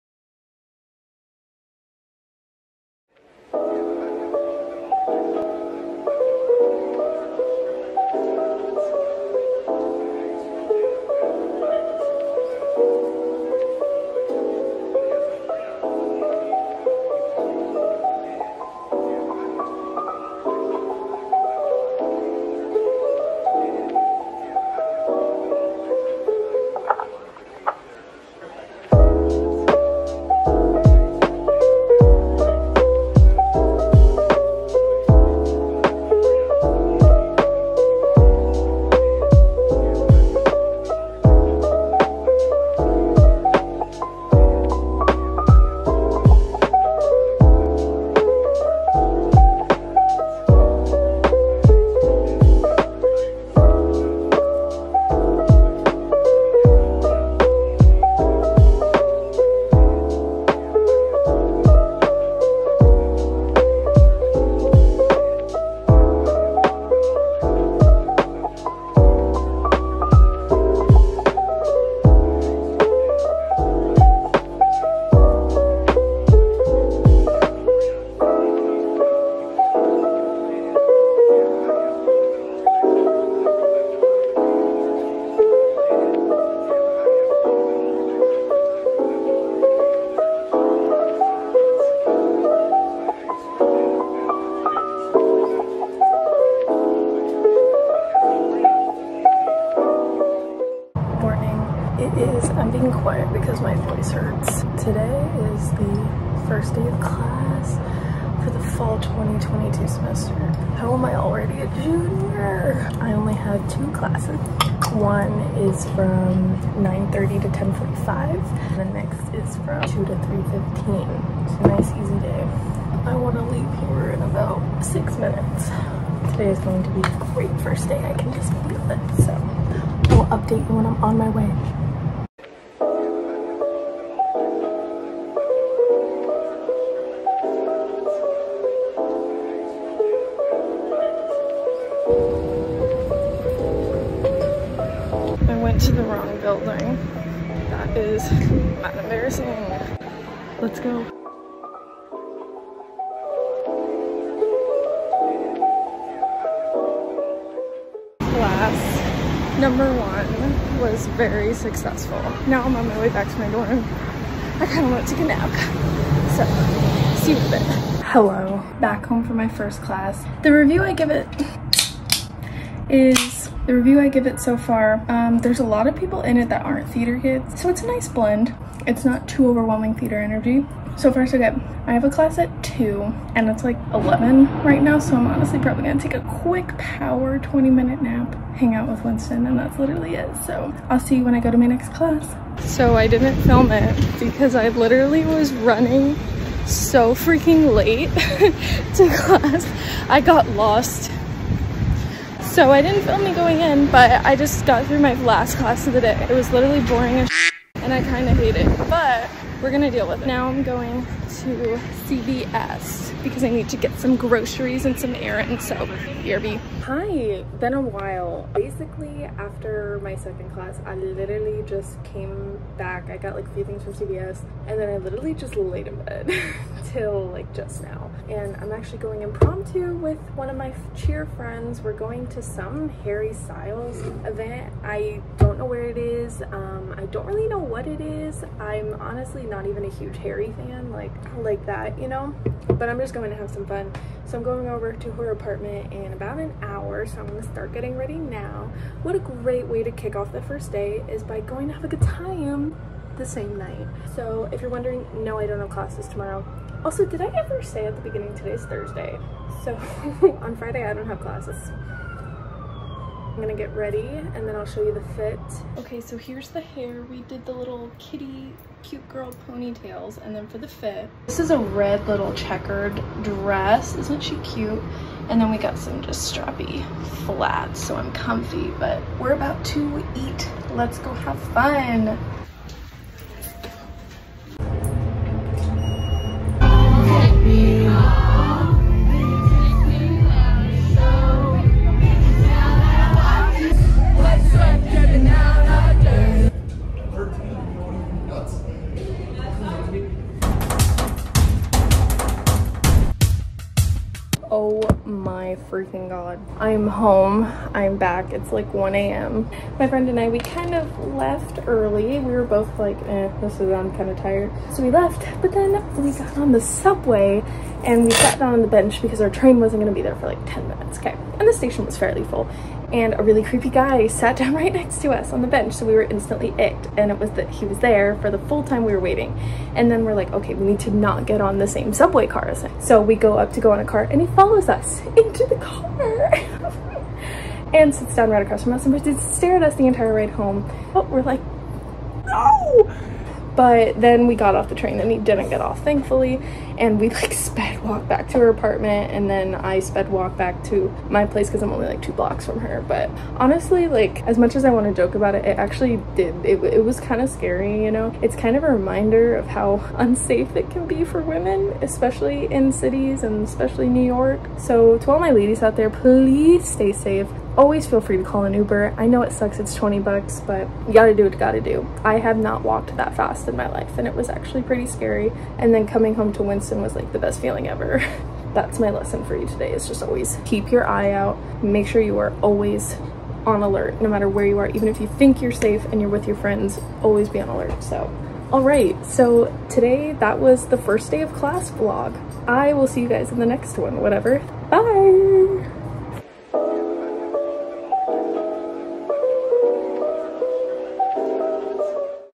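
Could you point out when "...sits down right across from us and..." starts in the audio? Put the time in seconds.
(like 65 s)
337 s.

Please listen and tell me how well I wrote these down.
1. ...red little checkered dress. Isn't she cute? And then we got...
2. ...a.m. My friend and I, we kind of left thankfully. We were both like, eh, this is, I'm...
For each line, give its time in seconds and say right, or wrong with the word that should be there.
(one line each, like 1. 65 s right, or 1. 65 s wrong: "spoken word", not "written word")
1. 271 s right
2. 308 s wrong: "early", not "thankfully".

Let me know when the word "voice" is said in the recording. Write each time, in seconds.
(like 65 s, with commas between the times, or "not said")
103 s.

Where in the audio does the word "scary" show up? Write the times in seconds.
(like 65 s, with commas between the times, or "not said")
357 s, 374 s.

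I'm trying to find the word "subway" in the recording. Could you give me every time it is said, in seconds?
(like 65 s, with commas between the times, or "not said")
316 s, 331 s.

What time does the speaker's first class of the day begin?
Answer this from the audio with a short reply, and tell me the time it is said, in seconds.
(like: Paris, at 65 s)
9:30, at 116 s.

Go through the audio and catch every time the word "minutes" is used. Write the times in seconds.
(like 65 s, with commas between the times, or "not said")
125 s, 187 s, 320 s.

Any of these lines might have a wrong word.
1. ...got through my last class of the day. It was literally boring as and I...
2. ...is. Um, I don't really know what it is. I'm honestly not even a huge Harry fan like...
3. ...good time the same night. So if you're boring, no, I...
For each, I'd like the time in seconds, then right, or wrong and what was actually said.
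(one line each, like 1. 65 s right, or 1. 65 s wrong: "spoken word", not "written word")
1. 204 s right
2. 235 s right
3. 251 s wrong: "wondering", not "boring".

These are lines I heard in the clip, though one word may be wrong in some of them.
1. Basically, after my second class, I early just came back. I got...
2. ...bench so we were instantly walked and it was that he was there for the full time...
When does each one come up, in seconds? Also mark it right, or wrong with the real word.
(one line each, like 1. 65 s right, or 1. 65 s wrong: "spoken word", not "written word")
1. 218 s wrong: "literally", not "early"
2. 325 s wrong: "icked", not "walked".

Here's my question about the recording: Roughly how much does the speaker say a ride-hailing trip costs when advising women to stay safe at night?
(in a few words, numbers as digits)
20 bucks.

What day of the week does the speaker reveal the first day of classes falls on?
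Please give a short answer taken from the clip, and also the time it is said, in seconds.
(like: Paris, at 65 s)
Thursday, at 258 s.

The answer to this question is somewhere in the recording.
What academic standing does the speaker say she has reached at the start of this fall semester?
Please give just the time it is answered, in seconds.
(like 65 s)
111 s.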